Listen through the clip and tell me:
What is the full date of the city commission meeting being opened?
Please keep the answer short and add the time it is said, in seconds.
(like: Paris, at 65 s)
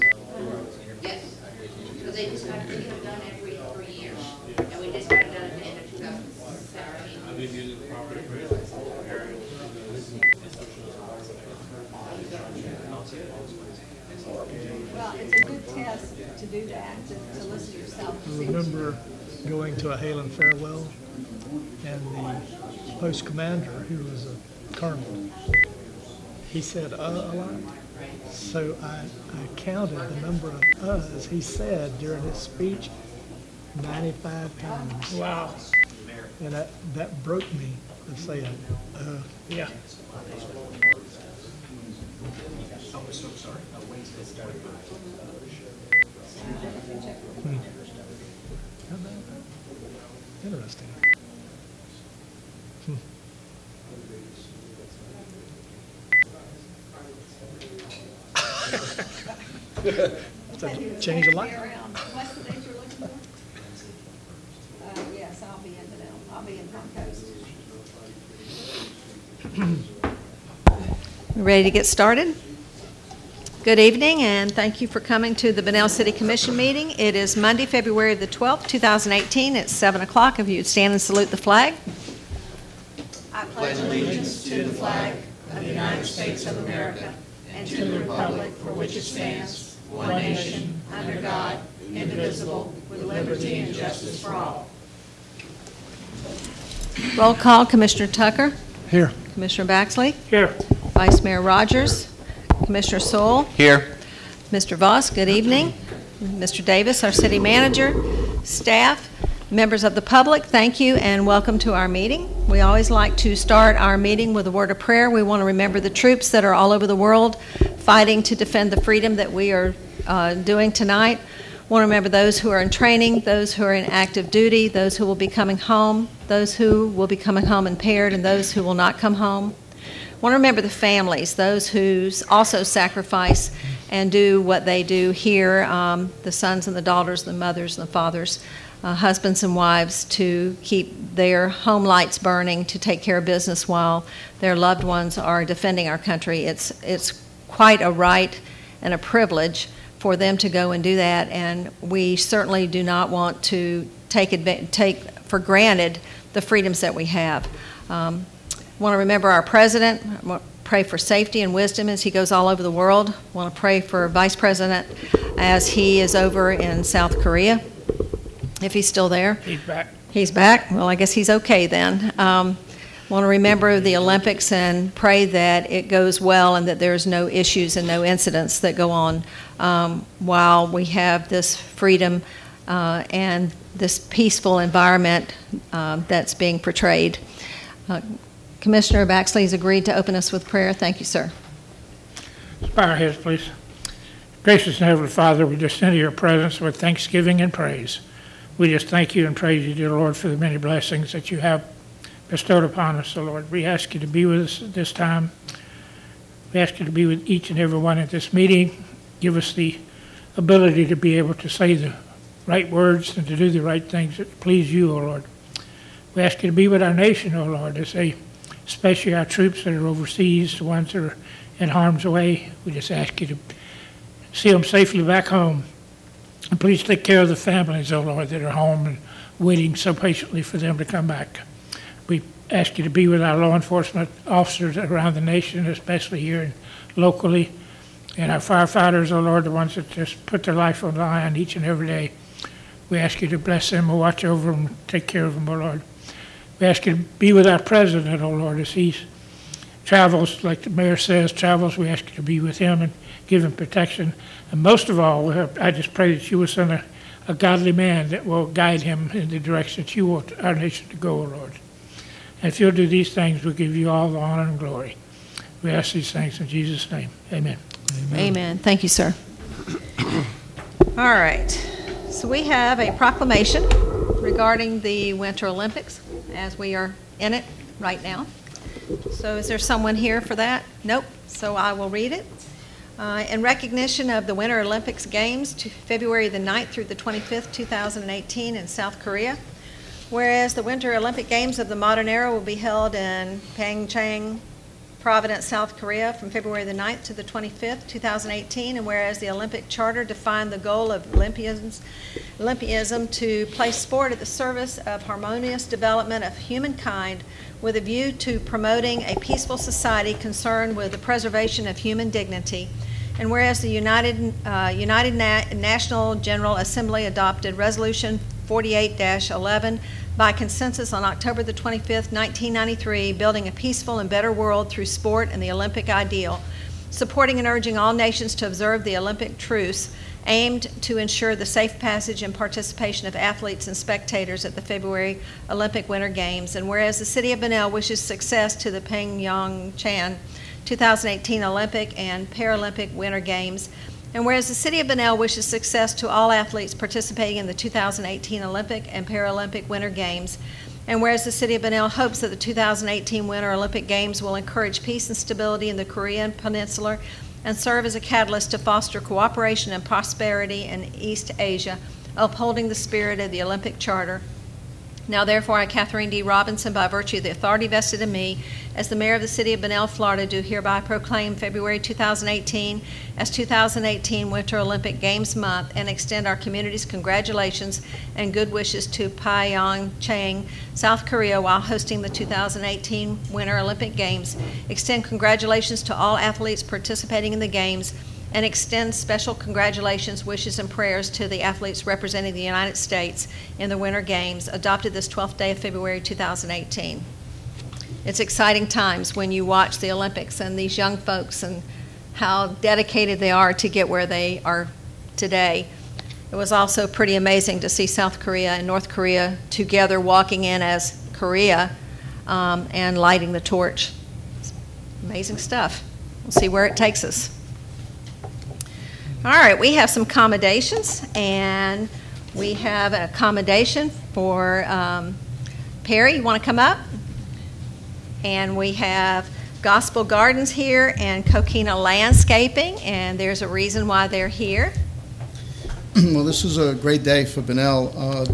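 February 12, 2018, at 77 s.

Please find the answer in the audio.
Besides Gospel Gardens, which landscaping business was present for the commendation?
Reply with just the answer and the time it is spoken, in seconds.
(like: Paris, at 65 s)
Coquina Landscaping, at 431 s.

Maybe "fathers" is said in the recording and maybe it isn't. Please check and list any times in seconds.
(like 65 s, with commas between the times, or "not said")
137 s, 195 s.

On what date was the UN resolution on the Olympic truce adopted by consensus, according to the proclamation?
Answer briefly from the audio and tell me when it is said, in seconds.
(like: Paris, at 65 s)
October 25, 1993, at 321 s.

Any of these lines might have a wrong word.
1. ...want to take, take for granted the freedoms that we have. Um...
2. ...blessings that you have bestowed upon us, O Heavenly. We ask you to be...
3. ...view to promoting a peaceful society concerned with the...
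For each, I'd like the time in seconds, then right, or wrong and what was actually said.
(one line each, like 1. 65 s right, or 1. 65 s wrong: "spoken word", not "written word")
1. 153 s right
2. 200 s wrong: "Lord", not "Heavenly"
3. 307 s right.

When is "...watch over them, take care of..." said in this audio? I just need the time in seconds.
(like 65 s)
243 s.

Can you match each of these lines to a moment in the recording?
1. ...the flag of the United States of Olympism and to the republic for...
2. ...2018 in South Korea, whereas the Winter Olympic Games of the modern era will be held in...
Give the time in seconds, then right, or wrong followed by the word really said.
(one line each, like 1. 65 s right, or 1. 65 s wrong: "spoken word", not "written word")
1. 84 s wrong: "America", not "Olympism"
2. 287 s right.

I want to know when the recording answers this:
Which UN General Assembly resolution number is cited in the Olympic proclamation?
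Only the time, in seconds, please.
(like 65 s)
317 s.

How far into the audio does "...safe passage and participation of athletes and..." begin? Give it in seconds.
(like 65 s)
331 s.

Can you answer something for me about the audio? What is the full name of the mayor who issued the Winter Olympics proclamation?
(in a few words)
Catherine D. Robinson.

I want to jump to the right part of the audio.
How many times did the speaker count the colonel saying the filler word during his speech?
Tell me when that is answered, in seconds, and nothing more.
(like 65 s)
33 s.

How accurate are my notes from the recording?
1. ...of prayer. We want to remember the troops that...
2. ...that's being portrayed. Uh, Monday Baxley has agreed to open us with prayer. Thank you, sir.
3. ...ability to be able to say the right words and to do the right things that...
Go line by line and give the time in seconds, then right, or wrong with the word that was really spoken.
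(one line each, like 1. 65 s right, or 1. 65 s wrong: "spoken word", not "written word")
1. 114 s right
2. 186 s wrong: "Commissioner", not "Monday"
3. 210 s right.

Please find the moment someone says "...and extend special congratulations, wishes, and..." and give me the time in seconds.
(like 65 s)
388 s.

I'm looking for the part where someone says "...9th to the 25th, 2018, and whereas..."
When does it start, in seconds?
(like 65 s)
296 s.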